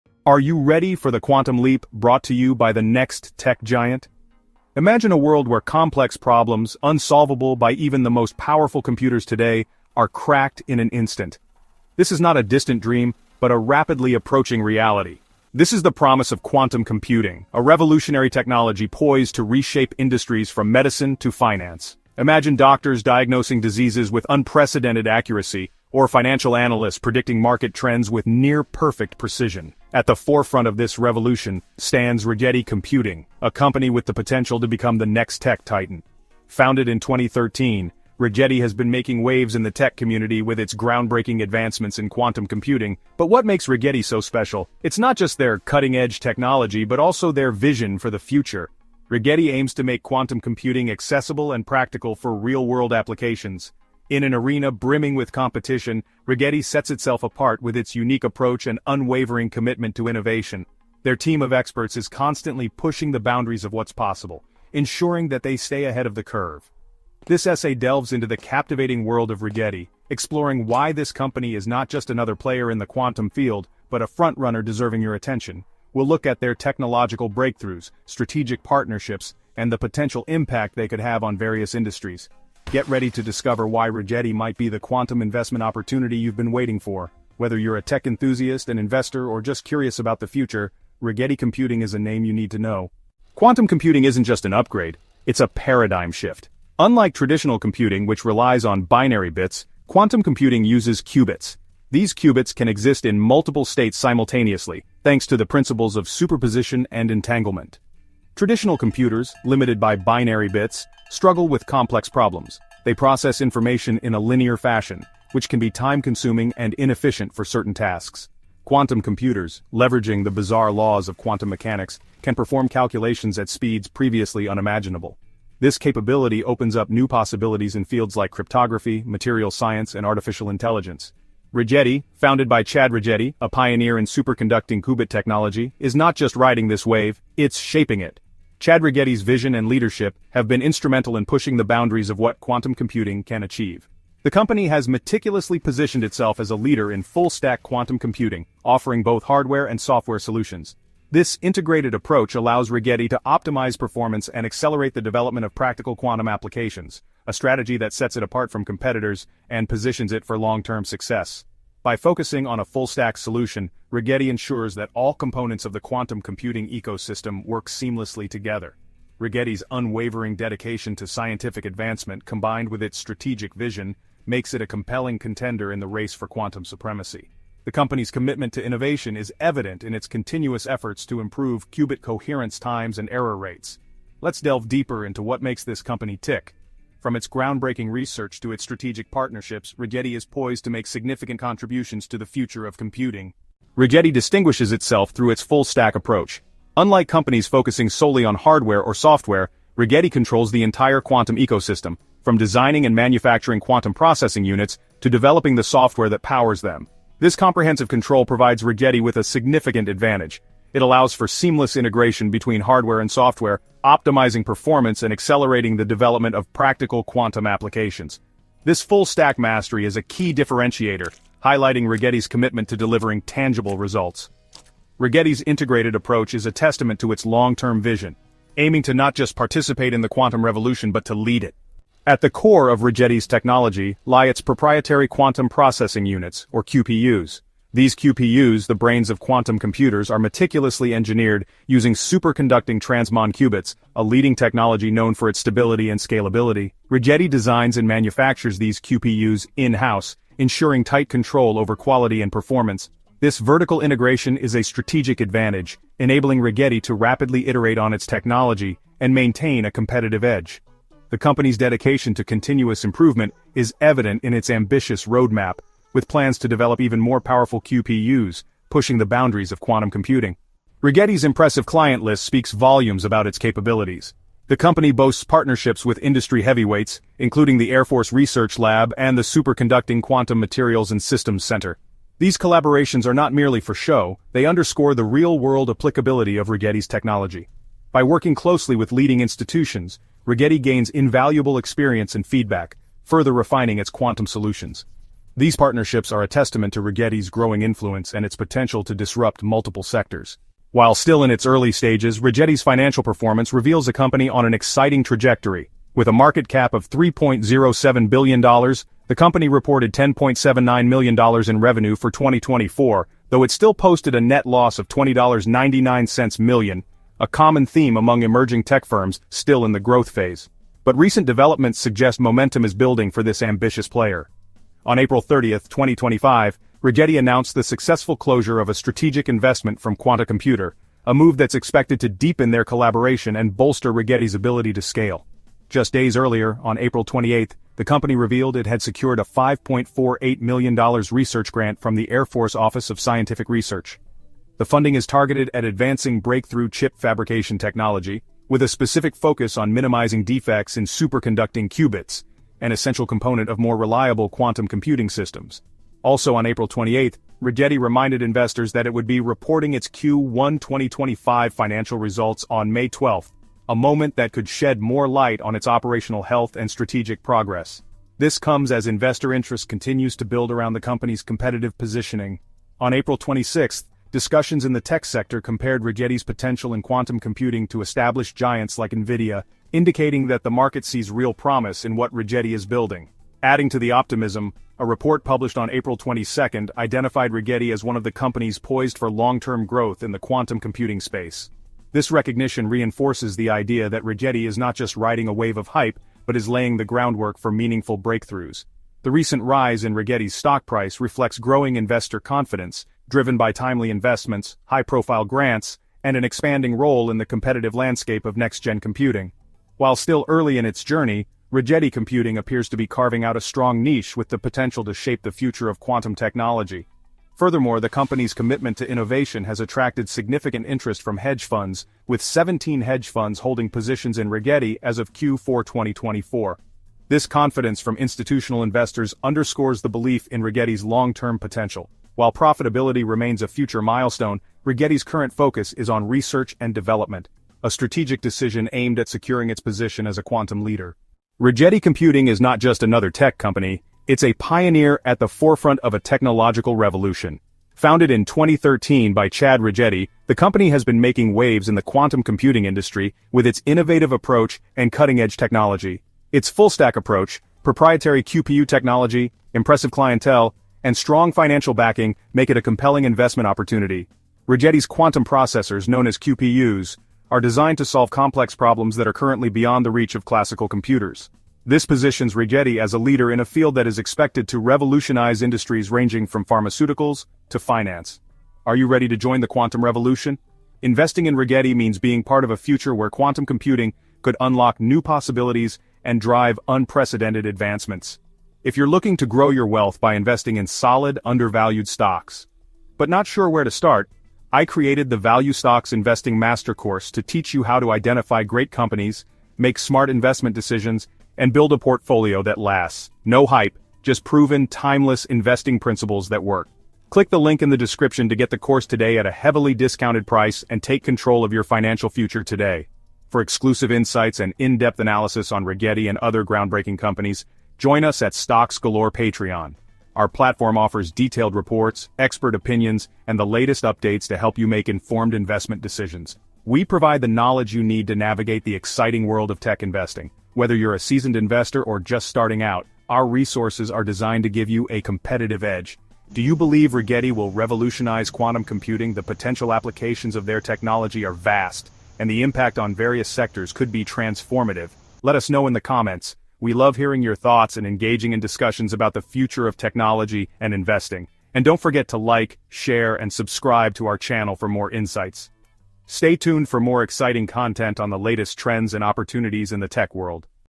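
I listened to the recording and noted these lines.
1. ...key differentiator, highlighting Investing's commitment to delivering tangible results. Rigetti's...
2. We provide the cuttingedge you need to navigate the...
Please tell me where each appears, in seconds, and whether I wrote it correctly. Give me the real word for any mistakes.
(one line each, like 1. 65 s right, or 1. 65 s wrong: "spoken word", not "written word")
1. 220 s wrong: "Rigetti", not "Investing"
2. 526 s wrong: "knowledge", not "cuttingedge".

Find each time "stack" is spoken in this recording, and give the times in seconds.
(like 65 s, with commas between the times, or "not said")
147 s, 162 s, 195 s, 218 s, 456 s.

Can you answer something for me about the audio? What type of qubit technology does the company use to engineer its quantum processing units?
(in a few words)
superconducting transmon qubits.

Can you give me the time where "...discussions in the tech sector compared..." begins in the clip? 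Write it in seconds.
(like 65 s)
374 s.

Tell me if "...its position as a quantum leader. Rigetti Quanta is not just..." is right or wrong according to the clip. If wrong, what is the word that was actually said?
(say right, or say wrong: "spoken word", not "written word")
wrong: "Computing", not "Quanta".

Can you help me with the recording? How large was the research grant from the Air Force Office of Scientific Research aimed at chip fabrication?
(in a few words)
$5.48 million.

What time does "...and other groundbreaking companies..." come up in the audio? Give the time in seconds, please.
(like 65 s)
516 s.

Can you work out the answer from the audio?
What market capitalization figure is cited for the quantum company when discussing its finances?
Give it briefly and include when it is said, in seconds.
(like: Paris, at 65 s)
$3.07 billion, at 306 s.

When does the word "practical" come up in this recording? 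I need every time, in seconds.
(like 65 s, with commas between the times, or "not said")
51 s, 155 s, 216 s.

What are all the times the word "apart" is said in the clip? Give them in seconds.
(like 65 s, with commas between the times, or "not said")
57 s, 158 s.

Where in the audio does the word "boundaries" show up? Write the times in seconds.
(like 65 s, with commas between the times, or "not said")
63 s, 141 s, 269 s.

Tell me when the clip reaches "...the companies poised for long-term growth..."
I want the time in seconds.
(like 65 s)
388 s.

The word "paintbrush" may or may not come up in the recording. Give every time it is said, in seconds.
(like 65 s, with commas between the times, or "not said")
not said.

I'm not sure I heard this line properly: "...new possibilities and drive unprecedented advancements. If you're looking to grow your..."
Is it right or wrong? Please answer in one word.
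right.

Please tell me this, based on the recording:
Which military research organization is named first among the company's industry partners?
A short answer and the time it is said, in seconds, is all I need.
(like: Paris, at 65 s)
Air Force Research Lab, at 277 s.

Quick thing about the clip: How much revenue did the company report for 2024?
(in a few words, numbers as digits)
$10.79 million.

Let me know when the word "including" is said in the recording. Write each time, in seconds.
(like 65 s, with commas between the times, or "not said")
277 s.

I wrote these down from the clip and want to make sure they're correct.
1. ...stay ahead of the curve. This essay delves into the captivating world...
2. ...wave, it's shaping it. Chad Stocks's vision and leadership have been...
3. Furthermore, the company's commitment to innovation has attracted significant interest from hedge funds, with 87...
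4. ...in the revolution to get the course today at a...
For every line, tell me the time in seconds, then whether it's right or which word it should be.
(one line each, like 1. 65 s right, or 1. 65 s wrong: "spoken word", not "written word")
1. 65 s right
2. 136 s wrong: "Rigetti", not "Stocks"
3. 417 s wrong: "17", not "87"
4. 507 s wrong: "description", not "revolution".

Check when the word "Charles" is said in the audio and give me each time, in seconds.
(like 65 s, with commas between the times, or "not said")
not said.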